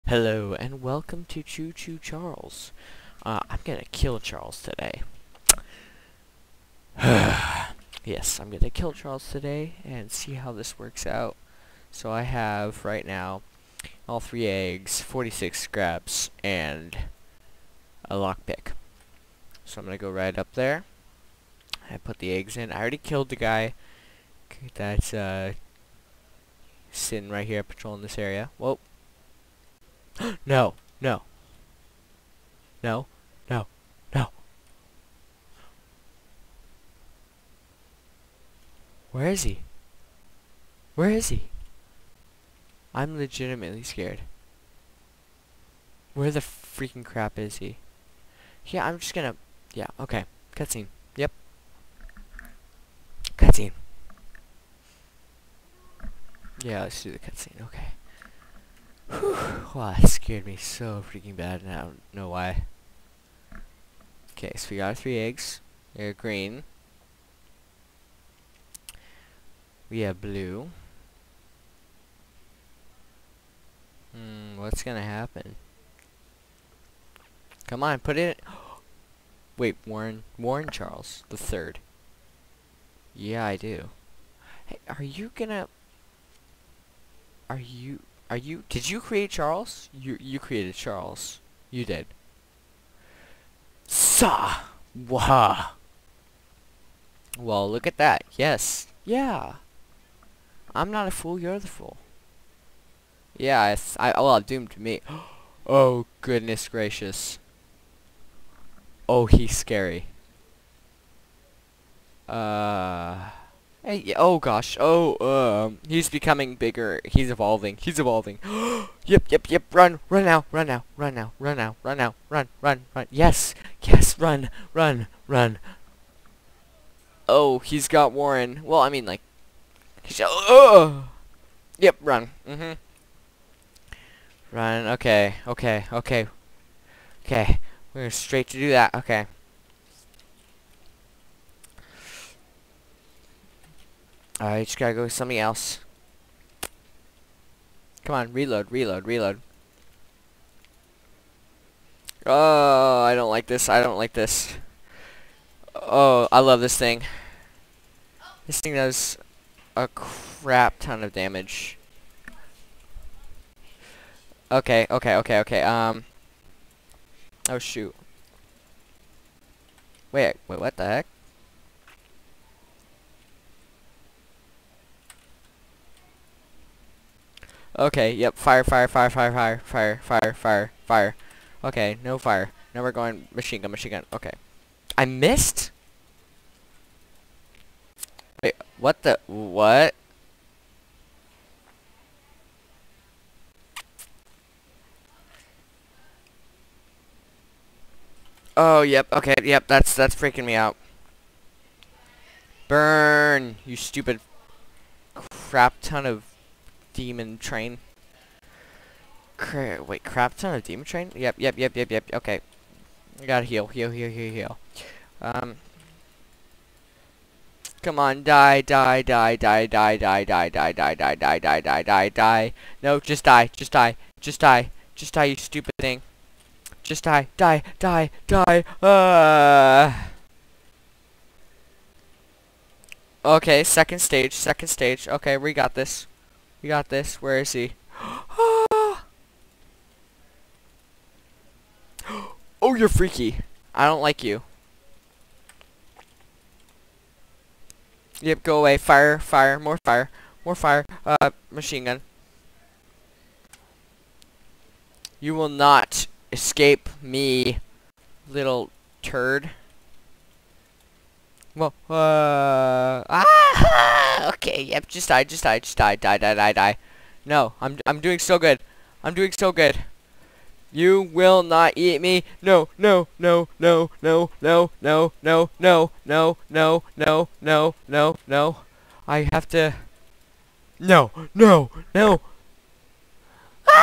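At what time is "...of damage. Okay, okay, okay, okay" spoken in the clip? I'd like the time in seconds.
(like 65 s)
161 s.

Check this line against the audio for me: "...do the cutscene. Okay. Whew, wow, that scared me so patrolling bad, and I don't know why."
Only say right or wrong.
wrong.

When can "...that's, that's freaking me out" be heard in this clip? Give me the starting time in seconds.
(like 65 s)
199 s.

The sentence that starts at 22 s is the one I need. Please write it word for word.
I already killed the guy that's uh, sitting right here patrolling this area.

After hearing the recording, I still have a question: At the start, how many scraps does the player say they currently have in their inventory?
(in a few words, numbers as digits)
46.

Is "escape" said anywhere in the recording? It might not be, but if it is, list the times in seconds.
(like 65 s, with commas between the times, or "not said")
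256 s.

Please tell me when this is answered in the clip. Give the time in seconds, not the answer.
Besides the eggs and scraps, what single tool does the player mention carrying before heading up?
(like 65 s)
18 s.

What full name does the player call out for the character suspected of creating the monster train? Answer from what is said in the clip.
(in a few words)
Warren Charles the Third.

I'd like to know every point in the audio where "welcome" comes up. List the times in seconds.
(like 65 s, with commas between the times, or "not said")
0 s.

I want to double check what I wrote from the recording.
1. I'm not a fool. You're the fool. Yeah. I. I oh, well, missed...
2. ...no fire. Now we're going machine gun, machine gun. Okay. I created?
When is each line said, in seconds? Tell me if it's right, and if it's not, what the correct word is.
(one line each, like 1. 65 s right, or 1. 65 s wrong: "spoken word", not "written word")
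1. 100 s wrong: "doomed", not "missed"
2. 182 s wrong: "missed", not "created".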